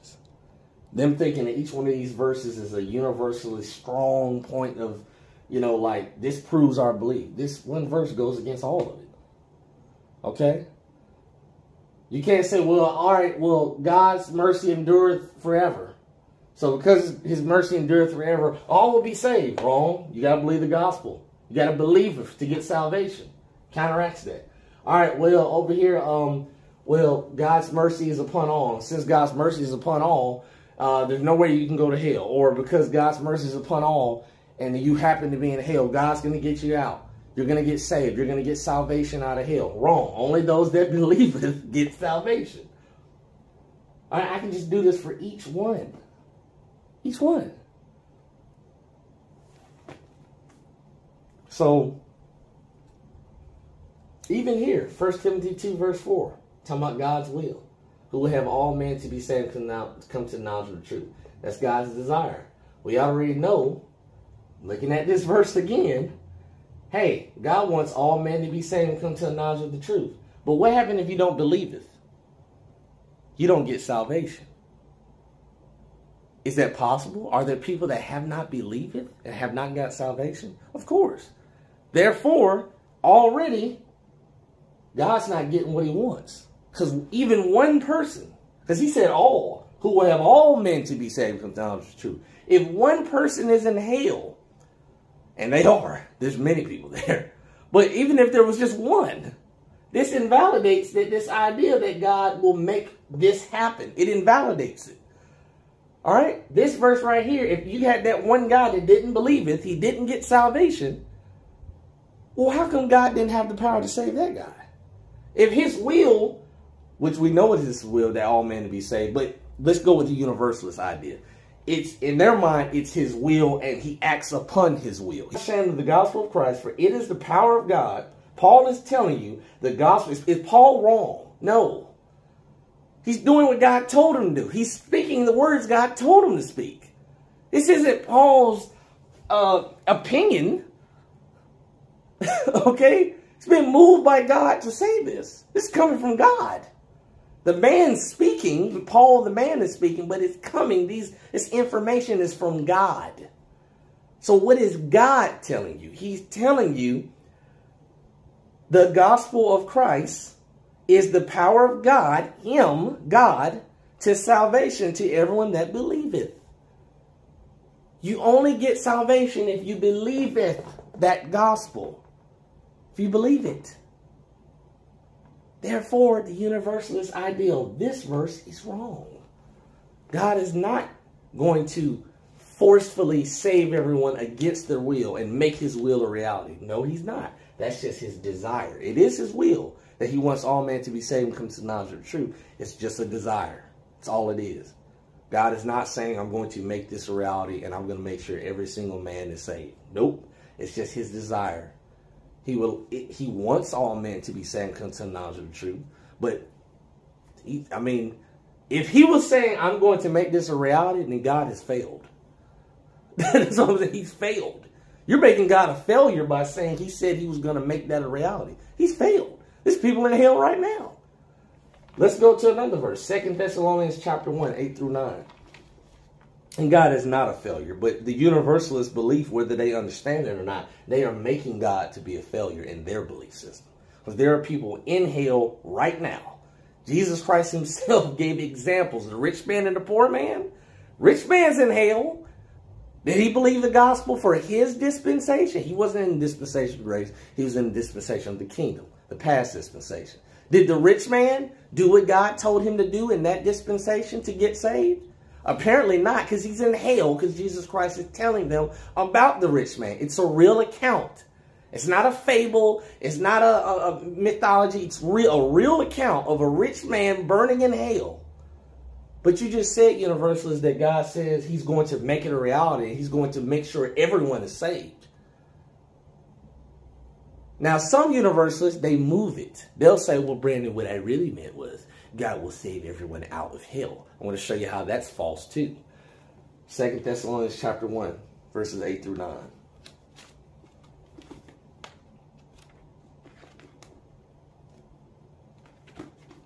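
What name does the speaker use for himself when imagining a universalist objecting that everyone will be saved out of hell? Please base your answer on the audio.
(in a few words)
Brandon.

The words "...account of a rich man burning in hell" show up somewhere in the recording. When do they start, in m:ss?
4:25.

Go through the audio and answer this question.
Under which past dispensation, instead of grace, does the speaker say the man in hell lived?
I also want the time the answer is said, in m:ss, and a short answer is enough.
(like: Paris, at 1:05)
The kingdom, at 4:07.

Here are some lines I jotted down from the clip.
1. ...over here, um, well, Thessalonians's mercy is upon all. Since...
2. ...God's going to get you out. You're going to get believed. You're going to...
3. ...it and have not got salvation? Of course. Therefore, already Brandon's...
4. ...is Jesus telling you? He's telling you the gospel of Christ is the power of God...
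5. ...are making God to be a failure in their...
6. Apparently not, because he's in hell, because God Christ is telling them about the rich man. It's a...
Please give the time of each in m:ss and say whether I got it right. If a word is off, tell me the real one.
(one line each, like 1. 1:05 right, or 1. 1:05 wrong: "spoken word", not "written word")
1. 0:25 wrong: "God", not "Thessalonians"
2. 0:35 wrong: "saved", not "believed"
3. 1:18 wrong: "God", not "Brandon"
4. 2:34 wrong: "God", not "Jesus"
5. 3:51 right
6. 4:15 wrong: "Jesus", not "God".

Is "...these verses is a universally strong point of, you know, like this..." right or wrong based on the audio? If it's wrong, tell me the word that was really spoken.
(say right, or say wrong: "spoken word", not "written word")
right.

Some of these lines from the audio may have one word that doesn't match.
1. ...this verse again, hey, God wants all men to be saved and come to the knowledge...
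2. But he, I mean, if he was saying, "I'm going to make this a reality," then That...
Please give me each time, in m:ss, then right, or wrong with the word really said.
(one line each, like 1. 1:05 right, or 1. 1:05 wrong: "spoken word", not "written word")
1. 1:05 right
2. 3:26 wrong: "God", not "That".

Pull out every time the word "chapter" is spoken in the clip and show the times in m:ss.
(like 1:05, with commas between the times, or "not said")
3:43, 4:47.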